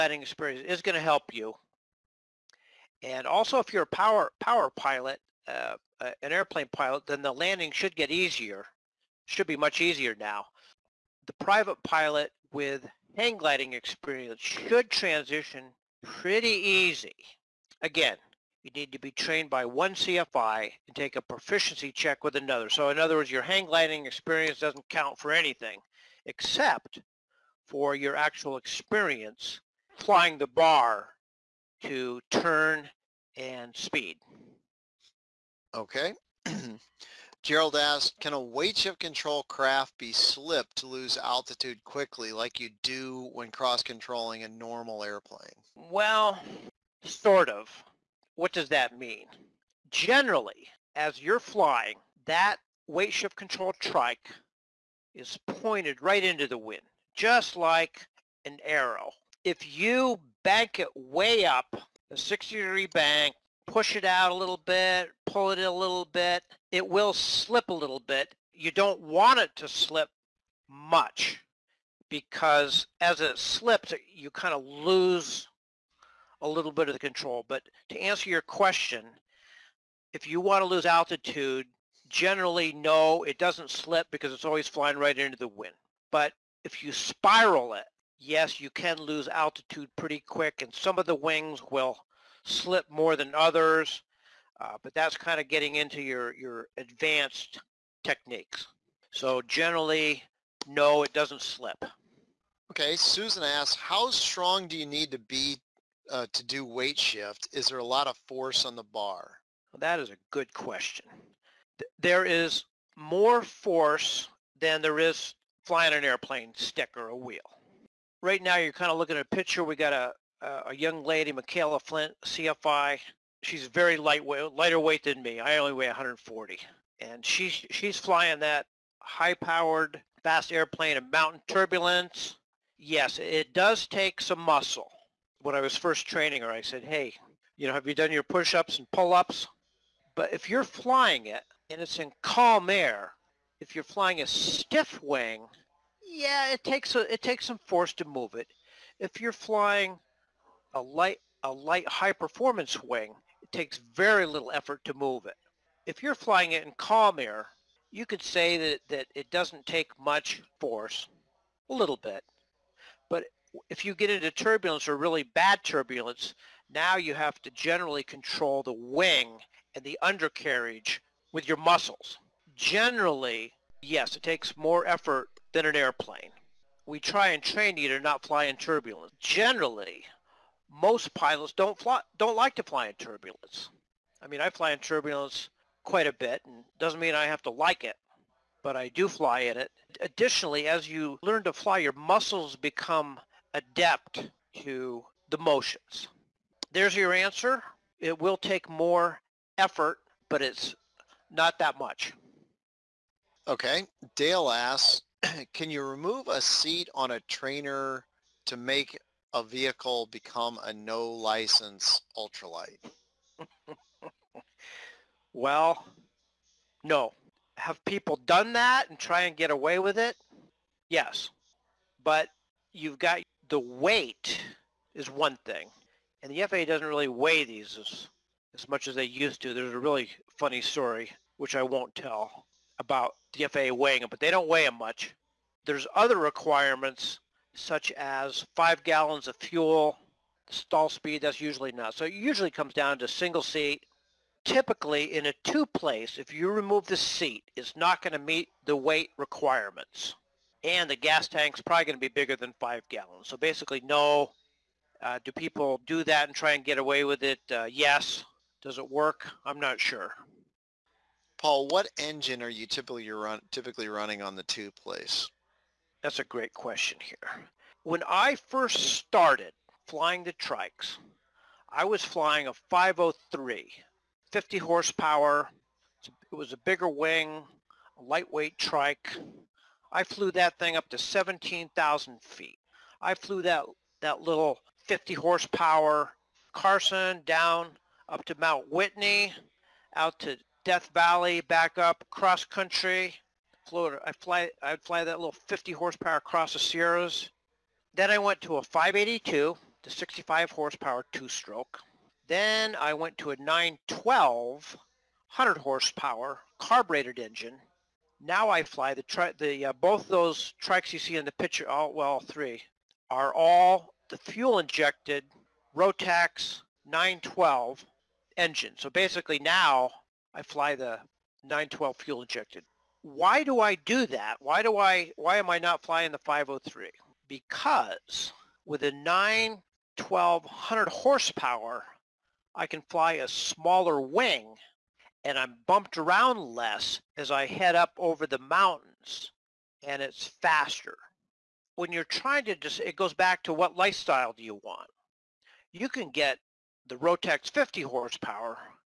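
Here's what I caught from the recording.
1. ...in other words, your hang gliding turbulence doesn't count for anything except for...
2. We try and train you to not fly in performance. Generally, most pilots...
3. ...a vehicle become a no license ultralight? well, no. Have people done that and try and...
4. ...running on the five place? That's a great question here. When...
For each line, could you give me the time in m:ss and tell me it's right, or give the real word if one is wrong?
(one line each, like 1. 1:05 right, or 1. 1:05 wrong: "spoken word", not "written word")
1. 0:22 wrong: "experience", not "turbulence"
2. 2:56 wrong: "turbulence", not "performance"
3. 3:29 right
4. 4:23 wrong: "two", not "five".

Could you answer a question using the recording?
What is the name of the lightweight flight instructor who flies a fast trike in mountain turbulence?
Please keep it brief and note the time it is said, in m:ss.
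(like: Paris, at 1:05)
Michaela Flint, at 2:01.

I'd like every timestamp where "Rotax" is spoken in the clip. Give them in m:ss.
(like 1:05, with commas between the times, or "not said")
5:15, 5:46.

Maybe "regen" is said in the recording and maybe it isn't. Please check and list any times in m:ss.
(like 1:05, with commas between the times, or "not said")
not said.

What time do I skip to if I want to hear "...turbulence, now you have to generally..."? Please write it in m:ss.
2:45.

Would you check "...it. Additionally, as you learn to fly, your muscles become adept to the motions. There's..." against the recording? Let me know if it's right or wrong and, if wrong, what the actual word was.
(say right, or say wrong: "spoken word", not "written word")
right.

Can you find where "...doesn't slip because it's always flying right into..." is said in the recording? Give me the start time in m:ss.
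1:23.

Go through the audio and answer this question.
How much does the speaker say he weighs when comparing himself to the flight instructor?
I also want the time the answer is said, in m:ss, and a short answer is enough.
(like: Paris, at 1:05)
140, at 2:05.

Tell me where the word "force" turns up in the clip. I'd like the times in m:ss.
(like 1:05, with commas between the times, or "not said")
1:48, 1:53, 2:27, 2:40.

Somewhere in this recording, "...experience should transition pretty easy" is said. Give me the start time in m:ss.
0:13.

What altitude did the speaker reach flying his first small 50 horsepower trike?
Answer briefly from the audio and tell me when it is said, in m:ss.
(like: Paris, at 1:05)
17,000 feet, at 4:40.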